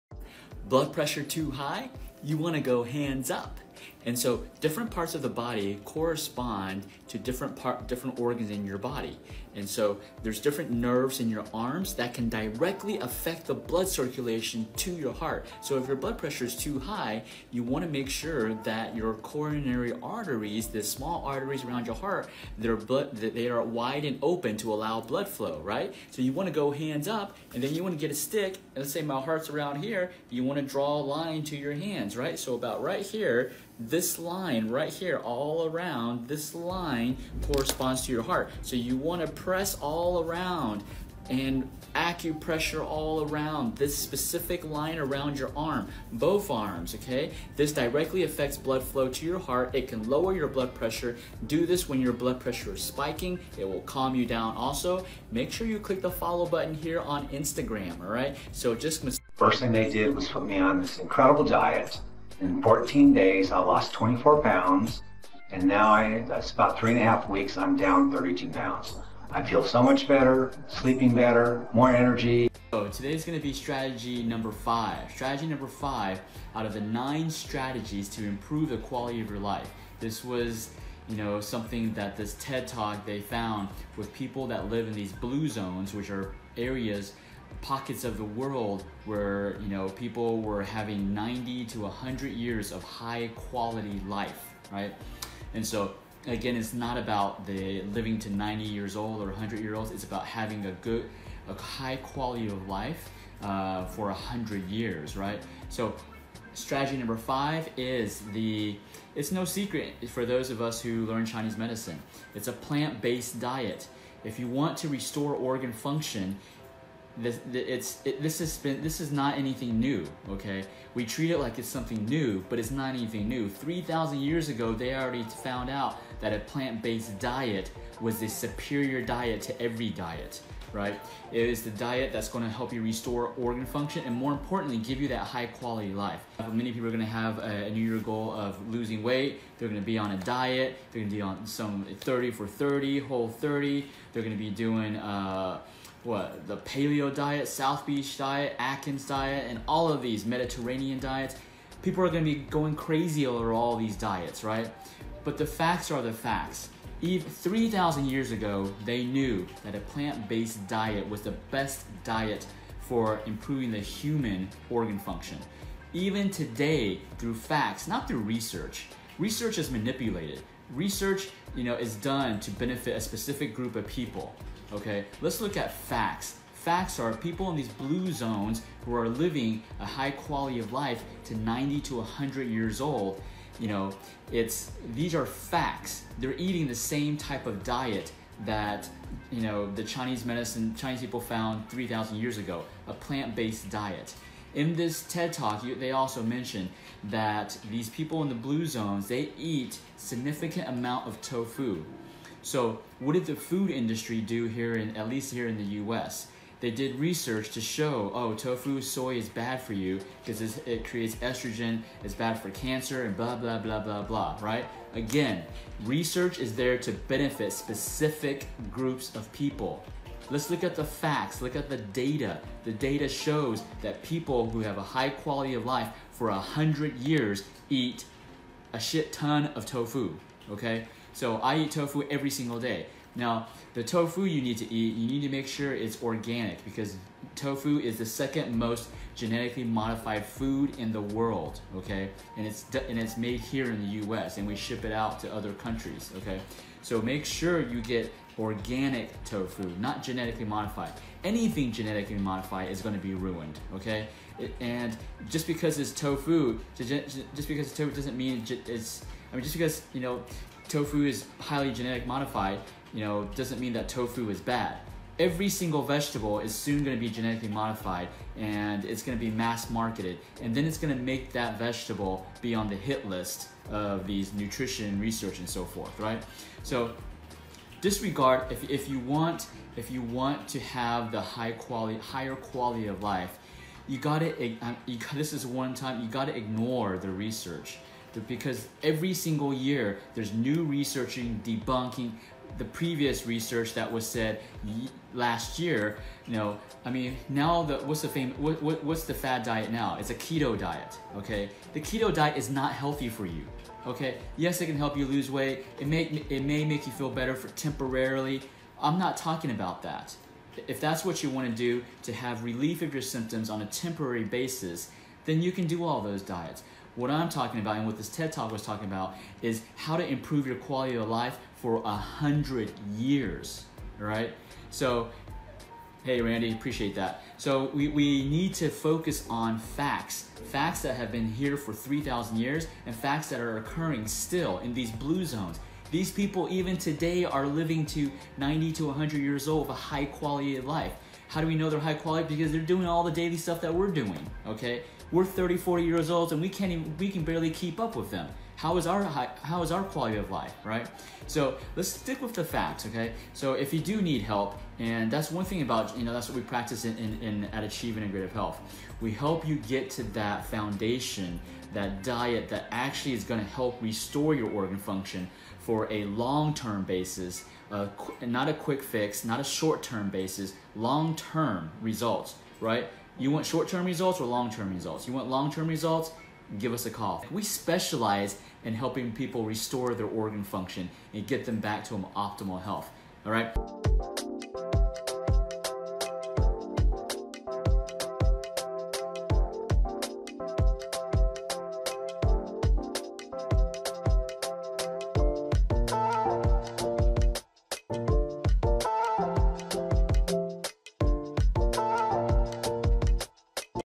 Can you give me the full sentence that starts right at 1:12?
So today's gonna be strategy number five.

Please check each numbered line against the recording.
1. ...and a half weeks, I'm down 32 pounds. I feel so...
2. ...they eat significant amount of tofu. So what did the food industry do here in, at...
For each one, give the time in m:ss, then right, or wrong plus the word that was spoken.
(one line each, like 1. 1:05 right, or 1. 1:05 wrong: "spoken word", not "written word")
1. 1:06 right
2. 3:19 right.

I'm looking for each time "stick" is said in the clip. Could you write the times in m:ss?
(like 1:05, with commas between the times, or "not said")
0:28, 5:51.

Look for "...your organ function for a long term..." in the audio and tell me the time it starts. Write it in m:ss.
6:04.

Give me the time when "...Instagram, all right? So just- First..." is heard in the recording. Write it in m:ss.
0:57.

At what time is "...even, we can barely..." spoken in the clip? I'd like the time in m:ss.
5:46.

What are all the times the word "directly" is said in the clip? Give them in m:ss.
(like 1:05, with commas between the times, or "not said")
0:12, 0:47.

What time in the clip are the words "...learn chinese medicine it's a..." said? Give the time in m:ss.
1:51.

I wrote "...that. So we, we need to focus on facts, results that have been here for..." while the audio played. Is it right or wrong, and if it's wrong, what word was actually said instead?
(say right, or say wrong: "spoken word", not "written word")
wrong: "facts", not "results".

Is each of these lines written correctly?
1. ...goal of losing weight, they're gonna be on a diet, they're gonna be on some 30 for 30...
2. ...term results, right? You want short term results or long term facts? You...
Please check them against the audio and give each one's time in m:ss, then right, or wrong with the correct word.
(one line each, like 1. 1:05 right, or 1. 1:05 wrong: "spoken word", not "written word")
1. 2:17 right
2. 6:11 wrong: "results", not "facts".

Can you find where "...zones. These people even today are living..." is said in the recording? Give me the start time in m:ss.
5:35.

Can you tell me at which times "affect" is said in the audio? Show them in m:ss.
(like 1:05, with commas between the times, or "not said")
0:12, 0:48.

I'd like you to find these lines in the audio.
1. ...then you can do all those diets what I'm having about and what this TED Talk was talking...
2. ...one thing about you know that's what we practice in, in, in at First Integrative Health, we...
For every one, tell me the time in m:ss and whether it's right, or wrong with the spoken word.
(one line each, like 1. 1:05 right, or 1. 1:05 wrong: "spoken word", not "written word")
1. 5:15 wrong: "talking", not "having"
2. 5:55 wrong: "Achieving", not "First".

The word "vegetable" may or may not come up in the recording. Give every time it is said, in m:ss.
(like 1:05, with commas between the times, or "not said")
4:25, 4:31.